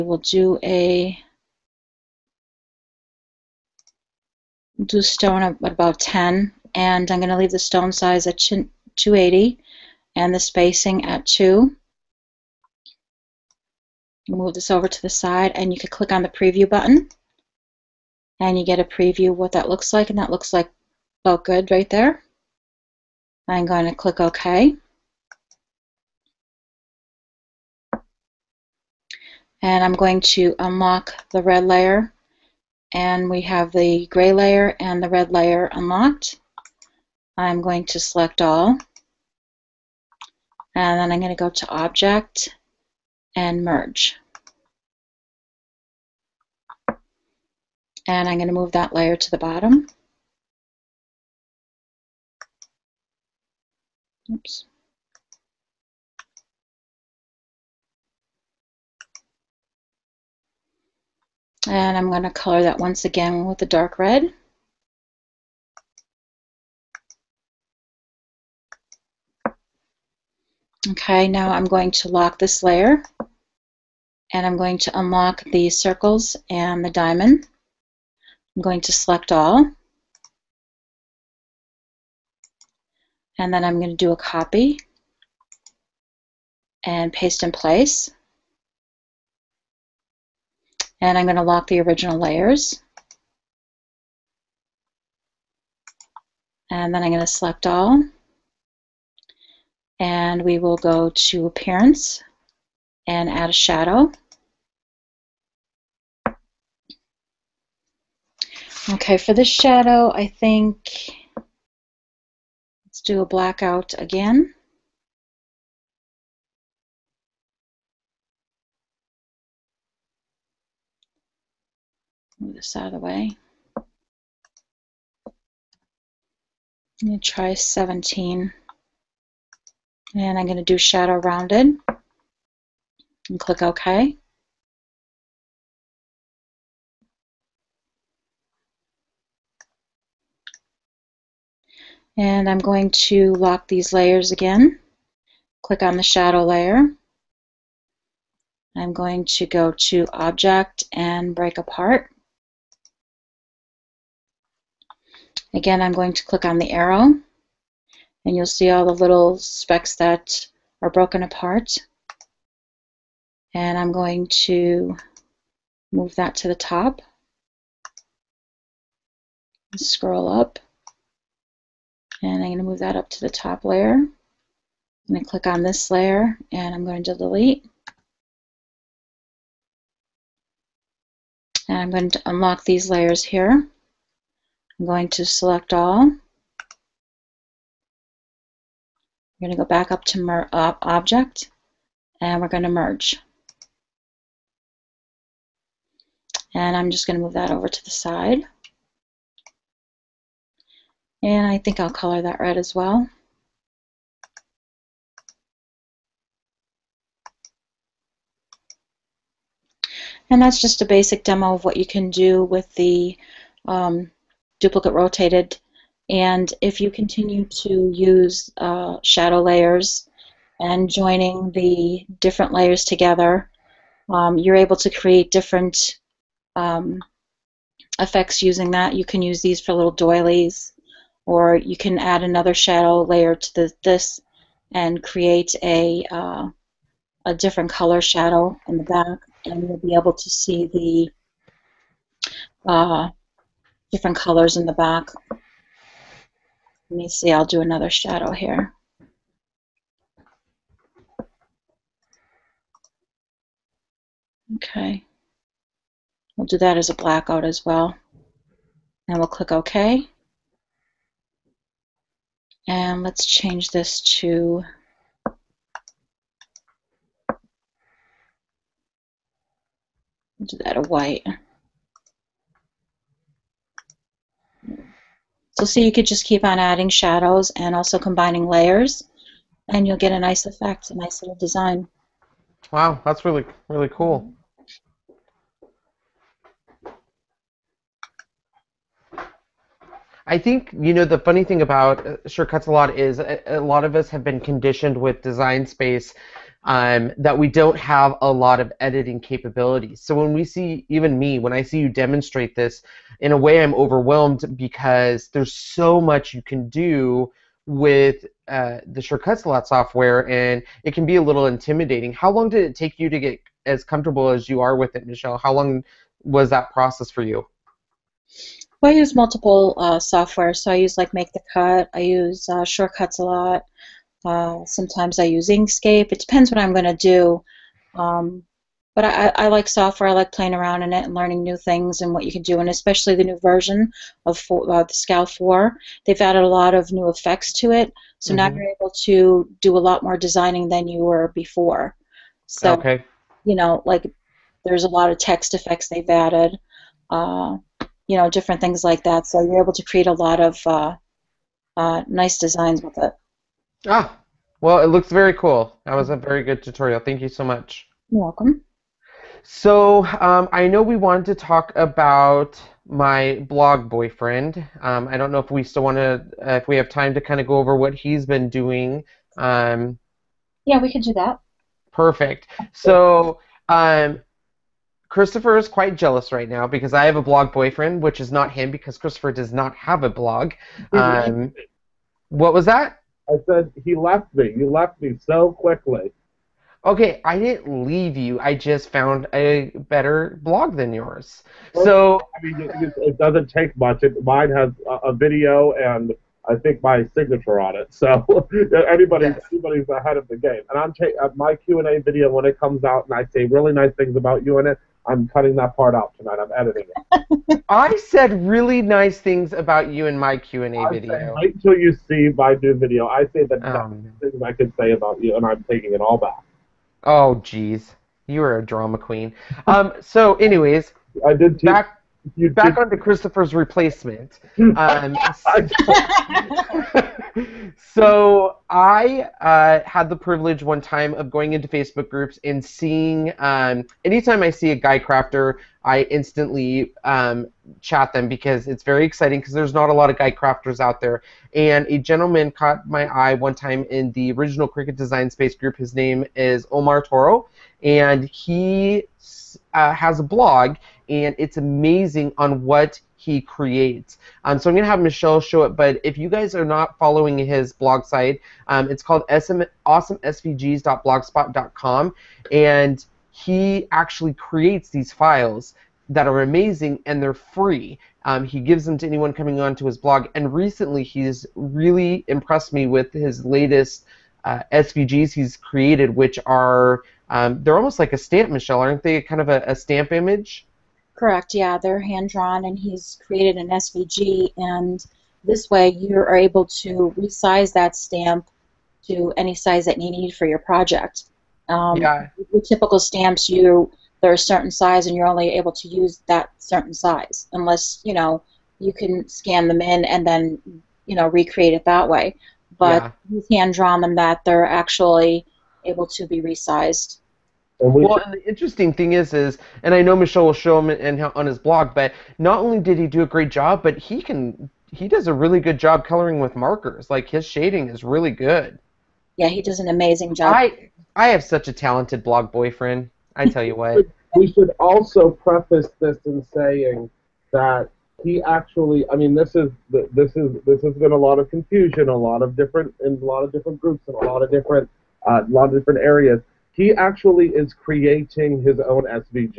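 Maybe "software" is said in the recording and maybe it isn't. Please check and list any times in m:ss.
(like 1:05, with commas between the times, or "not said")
5:09, 5:20, 5:29.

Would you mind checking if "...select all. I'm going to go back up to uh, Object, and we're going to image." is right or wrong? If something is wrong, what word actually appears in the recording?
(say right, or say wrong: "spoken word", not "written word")
wrong: "merge", not "image".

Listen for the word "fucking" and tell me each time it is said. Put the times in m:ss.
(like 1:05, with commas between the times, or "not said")
not said.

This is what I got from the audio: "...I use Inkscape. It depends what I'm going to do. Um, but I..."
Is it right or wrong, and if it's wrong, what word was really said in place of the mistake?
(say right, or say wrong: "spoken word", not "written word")
right.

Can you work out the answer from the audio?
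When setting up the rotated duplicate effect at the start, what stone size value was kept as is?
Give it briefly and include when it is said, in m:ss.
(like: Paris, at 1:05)
280, at 0:08.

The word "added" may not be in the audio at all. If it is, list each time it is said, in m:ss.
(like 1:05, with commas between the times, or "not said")
5:36, 5:46.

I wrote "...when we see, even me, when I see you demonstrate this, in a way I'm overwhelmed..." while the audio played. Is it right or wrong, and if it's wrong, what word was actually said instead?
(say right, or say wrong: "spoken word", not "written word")
right.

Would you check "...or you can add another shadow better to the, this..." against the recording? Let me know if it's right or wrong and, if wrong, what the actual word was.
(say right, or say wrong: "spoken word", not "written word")
wrong: "layer", not "better".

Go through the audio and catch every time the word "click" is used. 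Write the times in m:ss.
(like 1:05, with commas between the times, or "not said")
0:15, 0:23, 2:13, 2:25, 2:36, 2:55, 4:19.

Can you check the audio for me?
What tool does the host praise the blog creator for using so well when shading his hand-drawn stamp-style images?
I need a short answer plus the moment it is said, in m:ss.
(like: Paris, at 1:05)
Markers, at 8:36.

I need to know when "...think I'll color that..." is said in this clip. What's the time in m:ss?
3:21.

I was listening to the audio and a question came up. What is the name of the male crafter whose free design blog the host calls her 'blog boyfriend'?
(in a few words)
Omar Toro.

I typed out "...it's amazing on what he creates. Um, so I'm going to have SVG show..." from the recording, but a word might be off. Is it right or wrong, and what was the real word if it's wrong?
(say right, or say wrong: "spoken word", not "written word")
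wrong: "Michelle", not "SVG".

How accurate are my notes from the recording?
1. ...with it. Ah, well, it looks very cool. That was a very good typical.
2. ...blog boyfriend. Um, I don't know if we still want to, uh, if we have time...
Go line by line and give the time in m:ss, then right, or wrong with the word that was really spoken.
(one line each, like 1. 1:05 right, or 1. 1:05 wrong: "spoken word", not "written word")
1. 5:52 wrong: "tutorial", not "typical"
2. 6:03 right.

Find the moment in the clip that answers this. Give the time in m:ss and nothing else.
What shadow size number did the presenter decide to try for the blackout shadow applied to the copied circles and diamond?
2:07.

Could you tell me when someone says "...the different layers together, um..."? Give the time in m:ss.
3:41.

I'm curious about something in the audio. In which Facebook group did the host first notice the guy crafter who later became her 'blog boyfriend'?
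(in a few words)
Cricut Design Space group.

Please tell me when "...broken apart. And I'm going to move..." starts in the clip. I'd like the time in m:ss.
2:40.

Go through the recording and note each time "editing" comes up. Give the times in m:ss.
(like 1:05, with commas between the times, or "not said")
4:58, 6:46.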